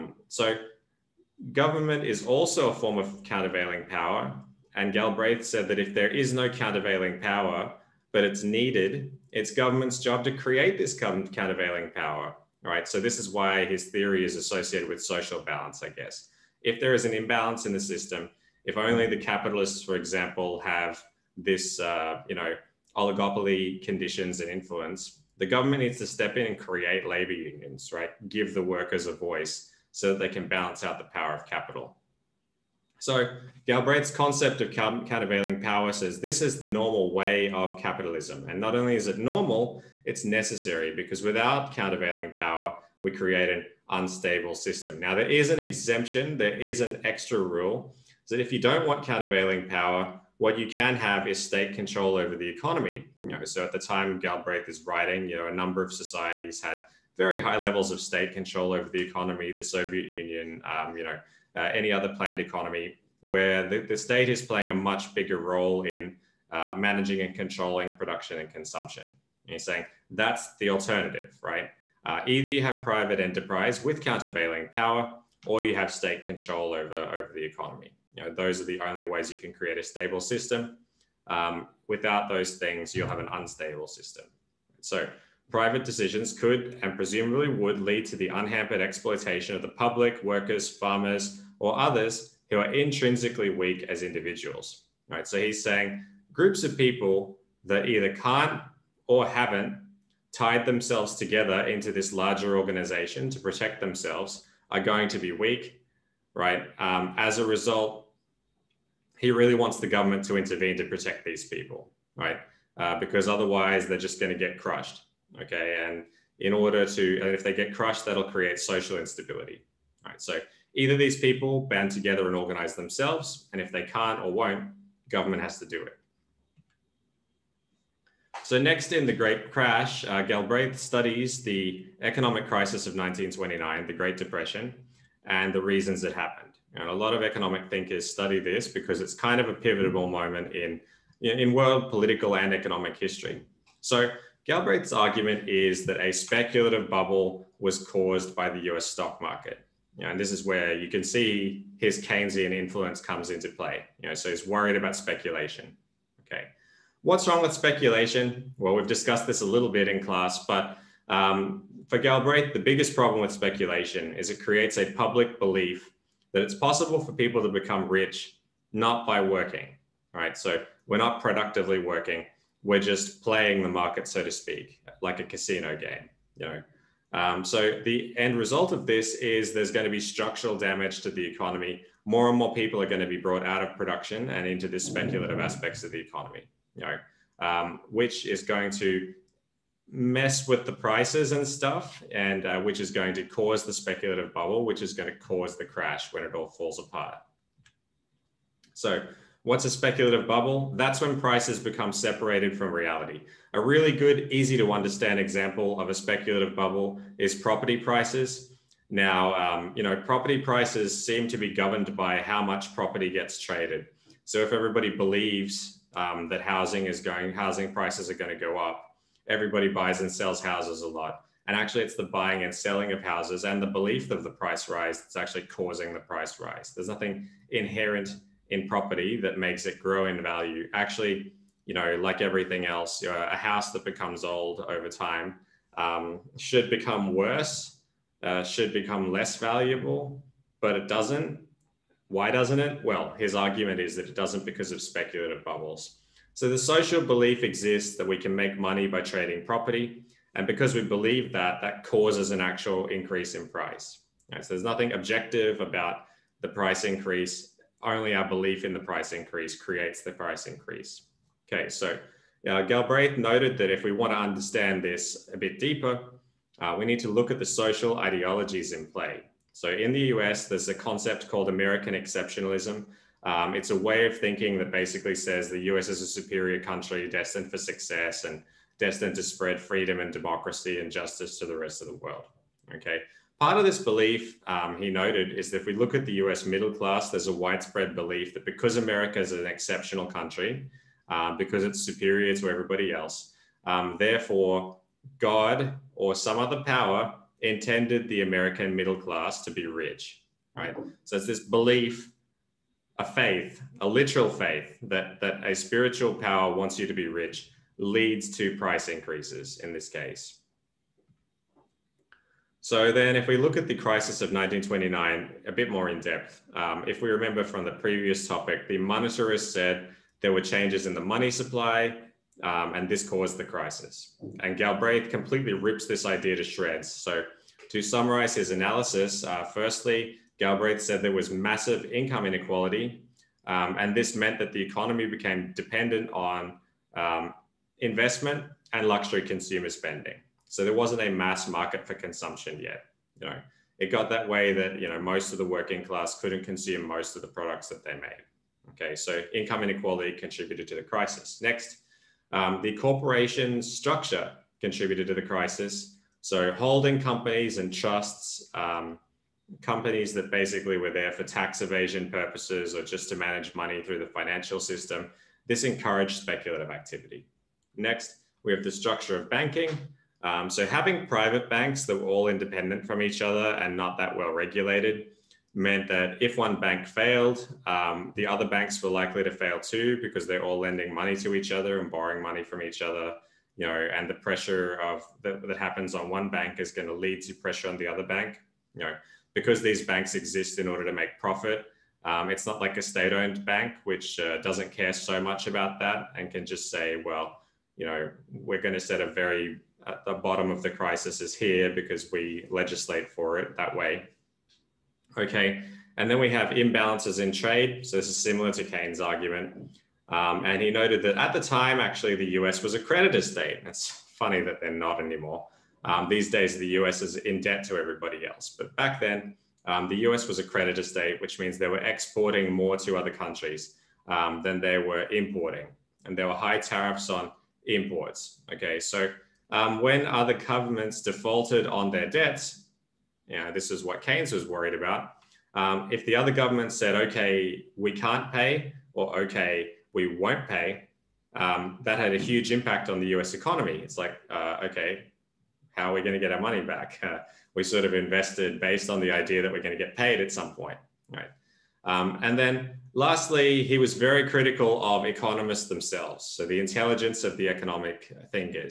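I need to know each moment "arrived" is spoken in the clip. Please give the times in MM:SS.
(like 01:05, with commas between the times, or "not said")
not said.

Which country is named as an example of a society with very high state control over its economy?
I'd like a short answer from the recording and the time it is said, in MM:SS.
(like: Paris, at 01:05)
Soviet Union, at 00:59.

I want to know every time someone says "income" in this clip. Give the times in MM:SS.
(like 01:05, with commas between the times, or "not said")
05:31, 05:49.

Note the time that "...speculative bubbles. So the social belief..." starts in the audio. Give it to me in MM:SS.
04:04.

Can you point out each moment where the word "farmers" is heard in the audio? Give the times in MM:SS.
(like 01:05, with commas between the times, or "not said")
01:30.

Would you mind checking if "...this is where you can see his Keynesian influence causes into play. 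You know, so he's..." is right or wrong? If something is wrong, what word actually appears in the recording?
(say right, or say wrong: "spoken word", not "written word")
wrong: "comes", not "causes".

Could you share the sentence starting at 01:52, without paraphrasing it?
Uh, because otherwise they're just going to get crushed, okay?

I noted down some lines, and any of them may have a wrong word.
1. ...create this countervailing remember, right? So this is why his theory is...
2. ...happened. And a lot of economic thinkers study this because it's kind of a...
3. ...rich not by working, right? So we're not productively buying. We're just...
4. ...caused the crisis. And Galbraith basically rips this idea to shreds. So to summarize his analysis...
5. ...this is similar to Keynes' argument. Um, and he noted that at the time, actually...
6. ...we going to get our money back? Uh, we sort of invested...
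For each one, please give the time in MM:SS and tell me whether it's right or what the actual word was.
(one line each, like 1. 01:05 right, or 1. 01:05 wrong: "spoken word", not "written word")
1. 00:10 wrong: "power", not "remember"
2. 02:16 right
3. 02:47 wrong: "working", not "buying"
4. 05:23 wrong: "completely", not "basically"
5. 06:47 right
6. 07:25 right.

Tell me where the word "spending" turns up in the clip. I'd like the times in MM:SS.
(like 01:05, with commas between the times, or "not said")
05:39.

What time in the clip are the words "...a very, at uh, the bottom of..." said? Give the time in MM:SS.
06:39.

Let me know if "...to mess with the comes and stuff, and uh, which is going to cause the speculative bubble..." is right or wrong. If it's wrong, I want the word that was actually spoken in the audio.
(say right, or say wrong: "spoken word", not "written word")
wrong: "prices", not "comes".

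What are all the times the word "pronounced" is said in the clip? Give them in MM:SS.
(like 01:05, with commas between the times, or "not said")
not said.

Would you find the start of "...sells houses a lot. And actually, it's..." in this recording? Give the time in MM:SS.
03:40.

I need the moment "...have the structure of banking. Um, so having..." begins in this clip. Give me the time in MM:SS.
06:08.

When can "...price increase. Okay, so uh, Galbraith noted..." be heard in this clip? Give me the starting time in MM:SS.
04:20.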